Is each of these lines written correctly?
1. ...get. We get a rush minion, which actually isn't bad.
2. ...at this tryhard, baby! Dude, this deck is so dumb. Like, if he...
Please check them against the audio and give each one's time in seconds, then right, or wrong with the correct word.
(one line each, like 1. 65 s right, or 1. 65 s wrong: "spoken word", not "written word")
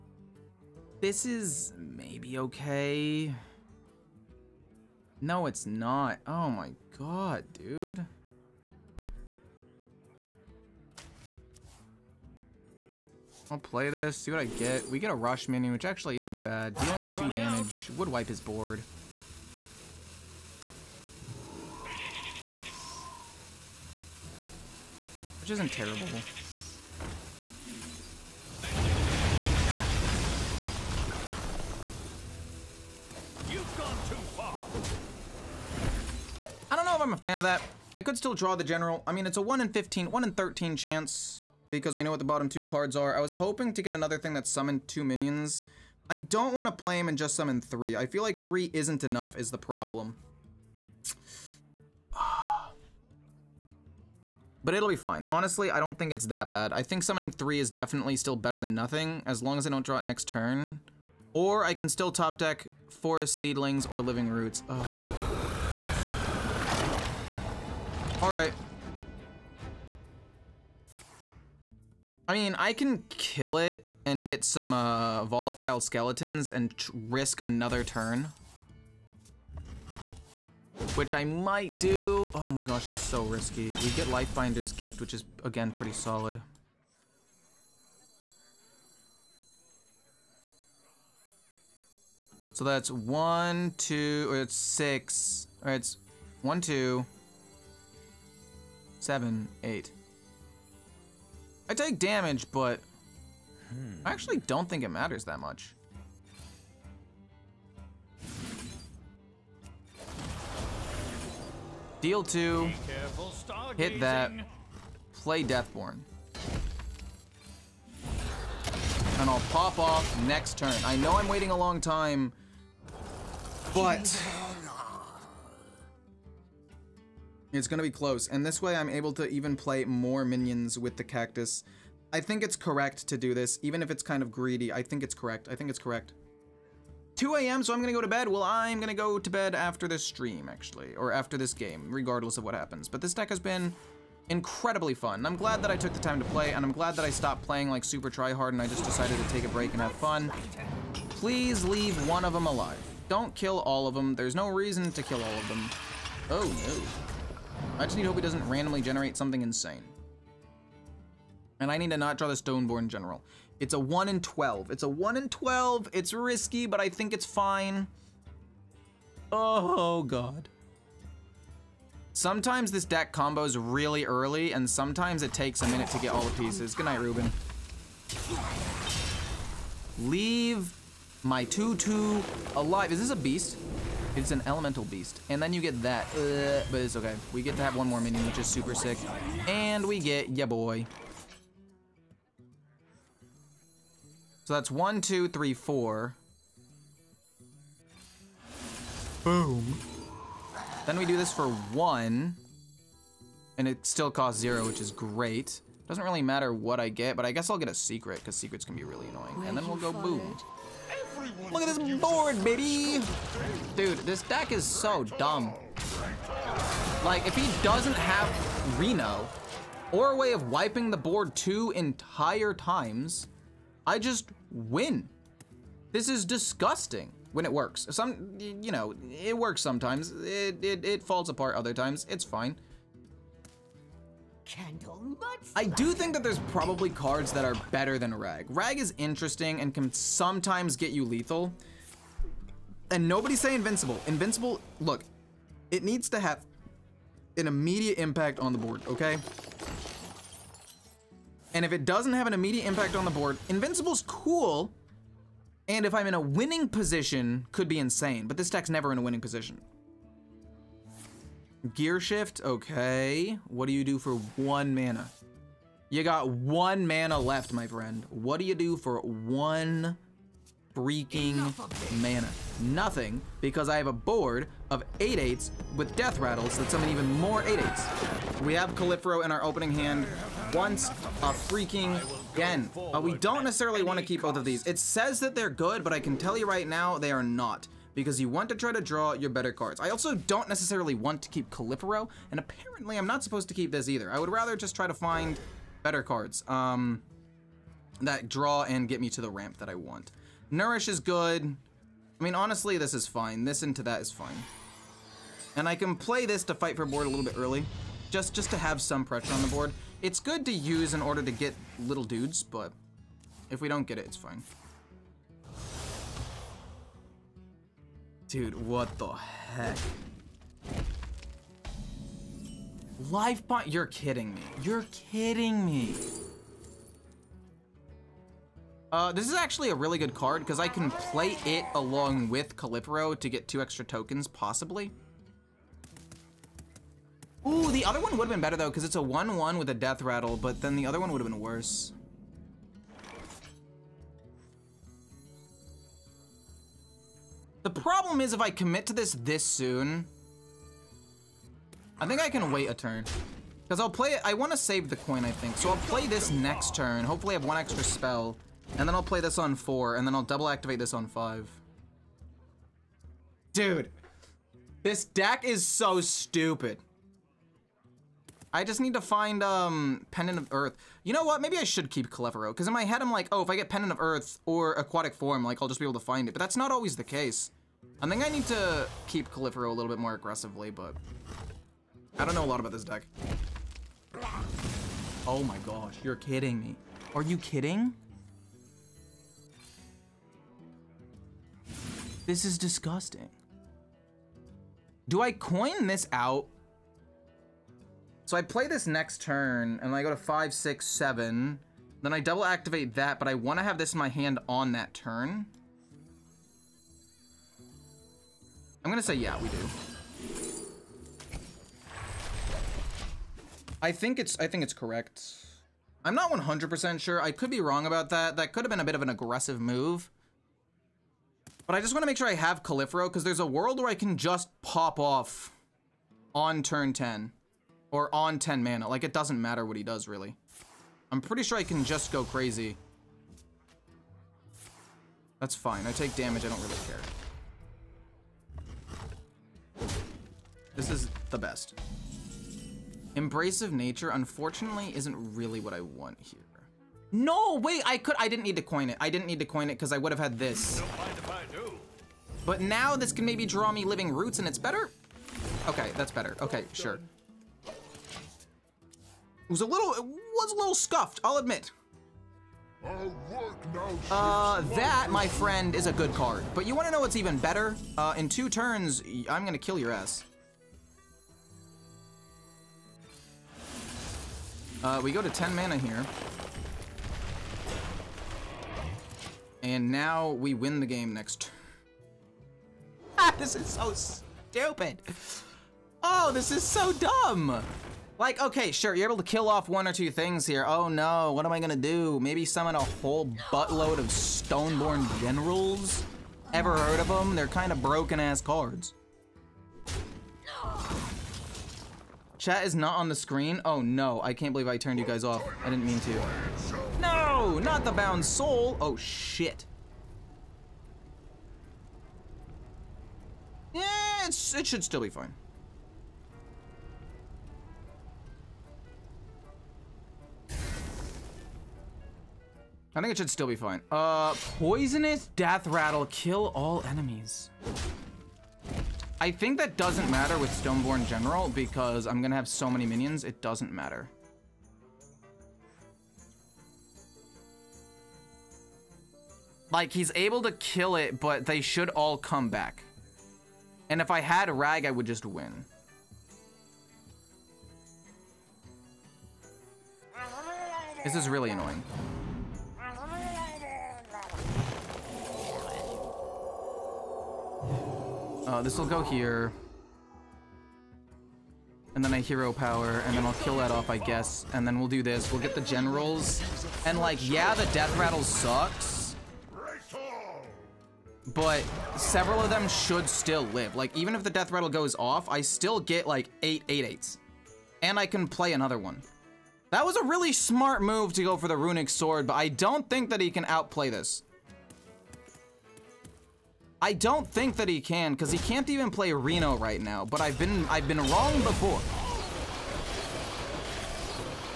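1. 14 s right
2. 211 s wrong: "board", not "tryhard".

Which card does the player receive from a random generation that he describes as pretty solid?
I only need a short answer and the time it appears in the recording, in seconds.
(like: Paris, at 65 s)
Lifebinder's Gift, at 84 s.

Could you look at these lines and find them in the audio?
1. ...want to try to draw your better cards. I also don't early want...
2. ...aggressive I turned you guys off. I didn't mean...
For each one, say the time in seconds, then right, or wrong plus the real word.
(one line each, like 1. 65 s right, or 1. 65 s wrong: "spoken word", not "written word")
1. 288 s wrong: "necessarily", not "early"
2. 504 s wrong: "believe", not "aggressive".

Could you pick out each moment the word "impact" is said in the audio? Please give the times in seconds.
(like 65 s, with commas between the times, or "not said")
247 s, 252 s.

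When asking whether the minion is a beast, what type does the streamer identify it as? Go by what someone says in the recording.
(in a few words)
elemental beast.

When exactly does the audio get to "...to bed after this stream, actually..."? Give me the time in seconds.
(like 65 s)
139 s.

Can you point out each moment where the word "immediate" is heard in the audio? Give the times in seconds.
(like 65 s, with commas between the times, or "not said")
247 s, 252 s.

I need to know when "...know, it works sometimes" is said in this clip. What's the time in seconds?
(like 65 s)
228 s.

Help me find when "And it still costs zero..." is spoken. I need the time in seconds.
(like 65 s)
203 s.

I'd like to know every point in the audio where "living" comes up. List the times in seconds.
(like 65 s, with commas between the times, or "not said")
64 s, 453 s.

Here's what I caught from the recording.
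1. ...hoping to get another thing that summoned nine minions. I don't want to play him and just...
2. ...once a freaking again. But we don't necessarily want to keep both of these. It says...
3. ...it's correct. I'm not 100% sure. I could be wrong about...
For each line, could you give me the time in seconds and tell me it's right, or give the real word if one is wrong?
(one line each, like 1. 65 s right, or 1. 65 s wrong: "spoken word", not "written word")
1. 43 s wrong: "two", not "nine"
2. 280 s right
3. 414 s right.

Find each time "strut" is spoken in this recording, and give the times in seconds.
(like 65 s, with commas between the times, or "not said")
not said.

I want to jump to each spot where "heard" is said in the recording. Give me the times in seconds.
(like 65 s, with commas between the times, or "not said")
496 s.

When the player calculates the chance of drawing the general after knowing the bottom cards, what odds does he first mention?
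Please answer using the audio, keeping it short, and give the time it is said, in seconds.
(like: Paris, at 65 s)
1 in 15, at 39 s.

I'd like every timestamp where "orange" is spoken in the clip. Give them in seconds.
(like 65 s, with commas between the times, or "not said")
not said.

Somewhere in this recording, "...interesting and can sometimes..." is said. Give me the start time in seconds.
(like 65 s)
238 s.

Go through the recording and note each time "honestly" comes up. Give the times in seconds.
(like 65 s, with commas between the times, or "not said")
55 s, 302 s.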